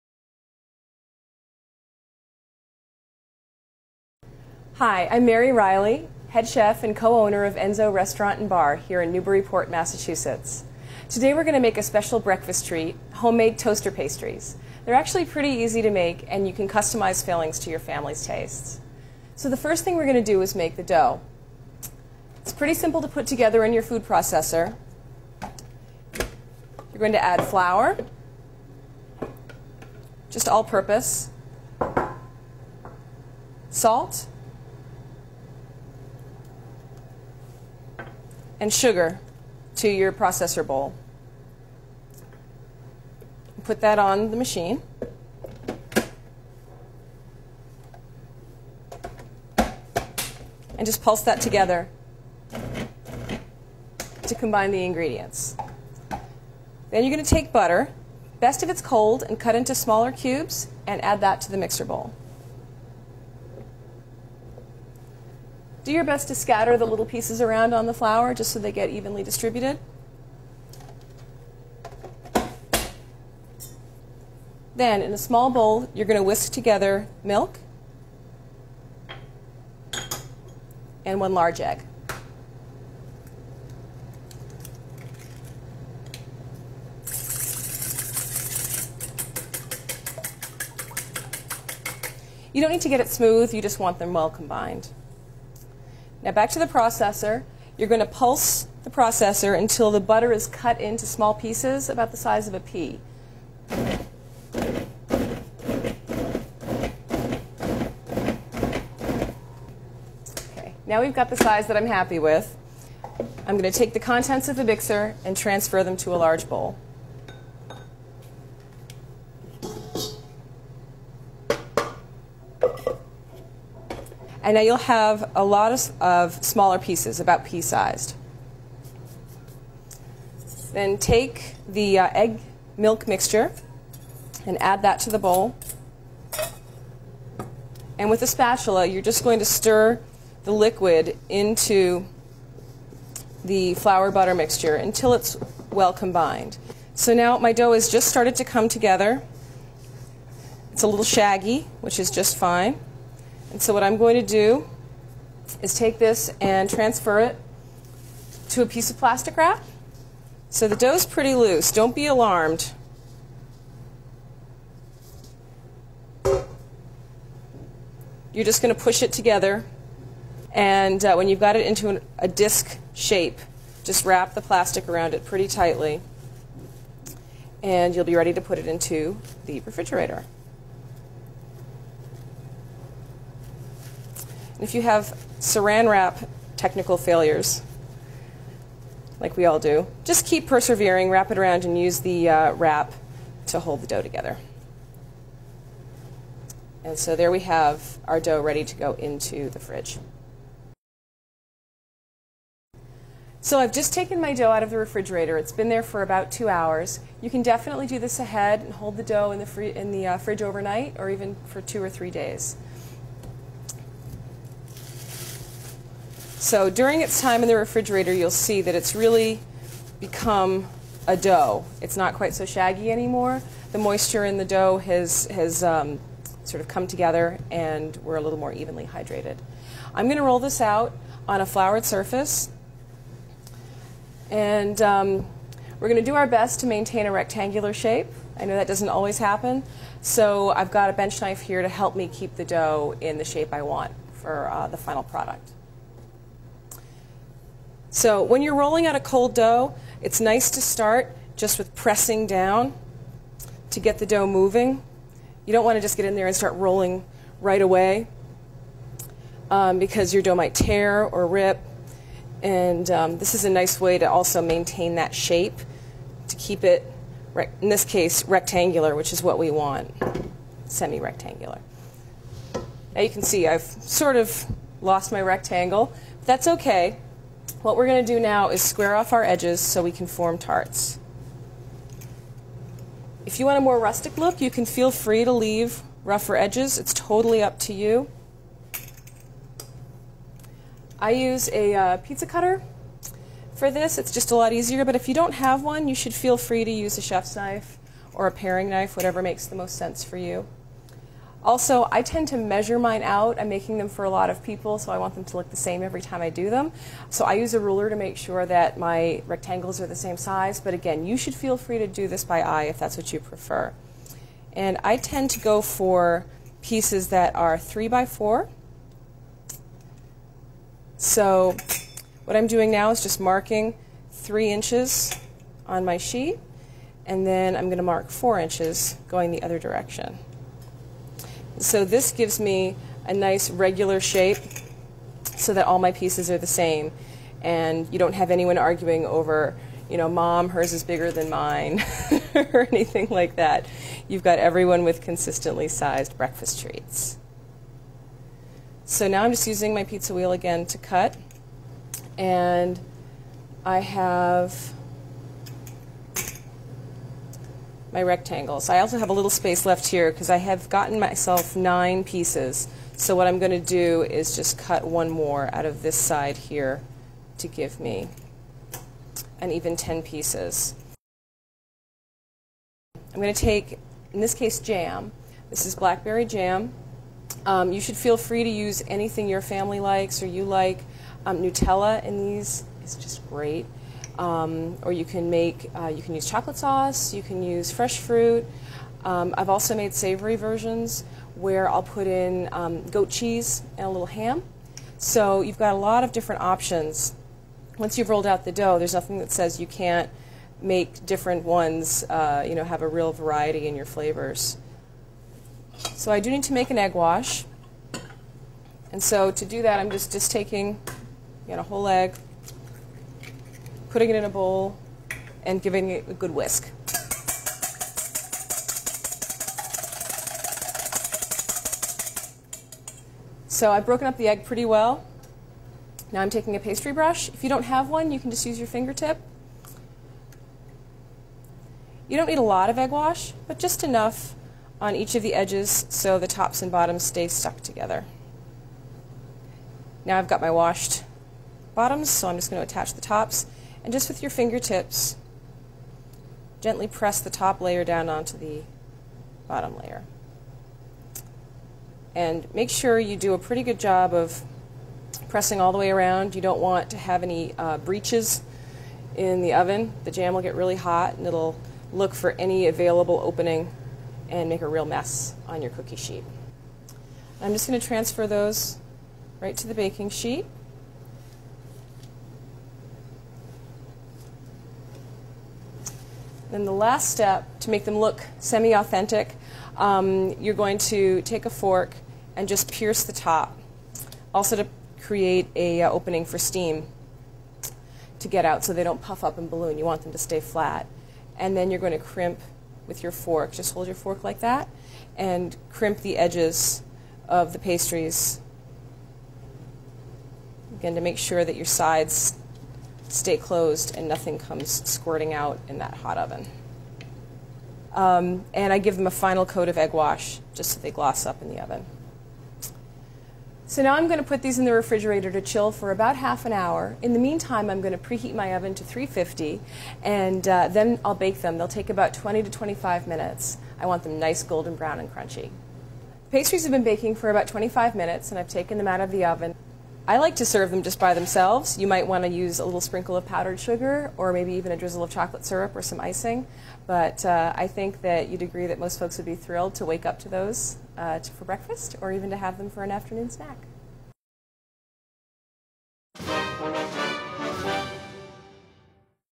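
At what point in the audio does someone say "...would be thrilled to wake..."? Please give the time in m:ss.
8:59.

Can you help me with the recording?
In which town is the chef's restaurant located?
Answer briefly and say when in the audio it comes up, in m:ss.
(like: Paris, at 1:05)
Newburyport, at 0:09.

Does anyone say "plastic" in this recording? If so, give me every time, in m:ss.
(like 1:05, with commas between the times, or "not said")
2:38, 2:54.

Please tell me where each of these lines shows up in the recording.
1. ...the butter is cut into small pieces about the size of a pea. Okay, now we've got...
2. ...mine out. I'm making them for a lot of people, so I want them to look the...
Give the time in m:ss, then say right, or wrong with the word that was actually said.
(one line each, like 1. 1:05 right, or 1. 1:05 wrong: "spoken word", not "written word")
1. 1:39 right
2. 5:02 right.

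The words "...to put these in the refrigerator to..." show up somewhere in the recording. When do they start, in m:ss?
8:34.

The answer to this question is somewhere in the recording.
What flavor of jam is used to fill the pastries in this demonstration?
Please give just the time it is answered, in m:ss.
6:15.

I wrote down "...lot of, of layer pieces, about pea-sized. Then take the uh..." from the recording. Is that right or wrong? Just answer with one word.
wrong.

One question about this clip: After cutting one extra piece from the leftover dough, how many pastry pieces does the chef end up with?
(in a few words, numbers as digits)
10.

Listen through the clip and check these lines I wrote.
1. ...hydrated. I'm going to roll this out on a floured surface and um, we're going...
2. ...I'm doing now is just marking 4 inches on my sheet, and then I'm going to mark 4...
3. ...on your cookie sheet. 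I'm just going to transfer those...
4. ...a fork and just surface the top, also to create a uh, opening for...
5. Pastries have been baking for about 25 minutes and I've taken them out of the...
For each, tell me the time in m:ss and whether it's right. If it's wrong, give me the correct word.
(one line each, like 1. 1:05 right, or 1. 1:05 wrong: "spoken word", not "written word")
1. 3:48 right
2. 5:22 wrong: "3", not "4"
3. 7:45 right
4. 8:01 wrong: "pierce", not "surface"
5. 8:46 right.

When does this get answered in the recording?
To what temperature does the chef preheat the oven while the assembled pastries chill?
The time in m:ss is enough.
8:38.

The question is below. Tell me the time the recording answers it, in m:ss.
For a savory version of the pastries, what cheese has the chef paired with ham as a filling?
6:32.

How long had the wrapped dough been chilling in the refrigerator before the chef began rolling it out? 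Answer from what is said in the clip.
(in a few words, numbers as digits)
about 2 hours.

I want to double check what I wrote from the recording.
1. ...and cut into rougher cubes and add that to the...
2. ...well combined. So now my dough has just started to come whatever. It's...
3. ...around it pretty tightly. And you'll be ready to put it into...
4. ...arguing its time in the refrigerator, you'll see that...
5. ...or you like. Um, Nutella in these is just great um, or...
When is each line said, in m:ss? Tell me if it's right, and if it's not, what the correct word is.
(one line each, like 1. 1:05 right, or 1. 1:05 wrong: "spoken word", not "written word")
1. 0:59 wrong: "smaller", not "rougher"
2. 2:25 wrong: "together", not "whatever"
3. 2:54 right
4. 3:36 wrong: "during", not "arguing"
5. 6:20 right.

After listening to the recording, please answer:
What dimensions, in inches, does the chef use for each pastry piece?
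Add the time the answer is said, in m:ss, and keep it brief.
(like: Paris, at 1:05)
3 by 4, at 5:17.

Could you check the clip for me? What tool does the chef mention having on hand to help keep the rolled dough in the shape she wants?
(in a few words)
bench knife.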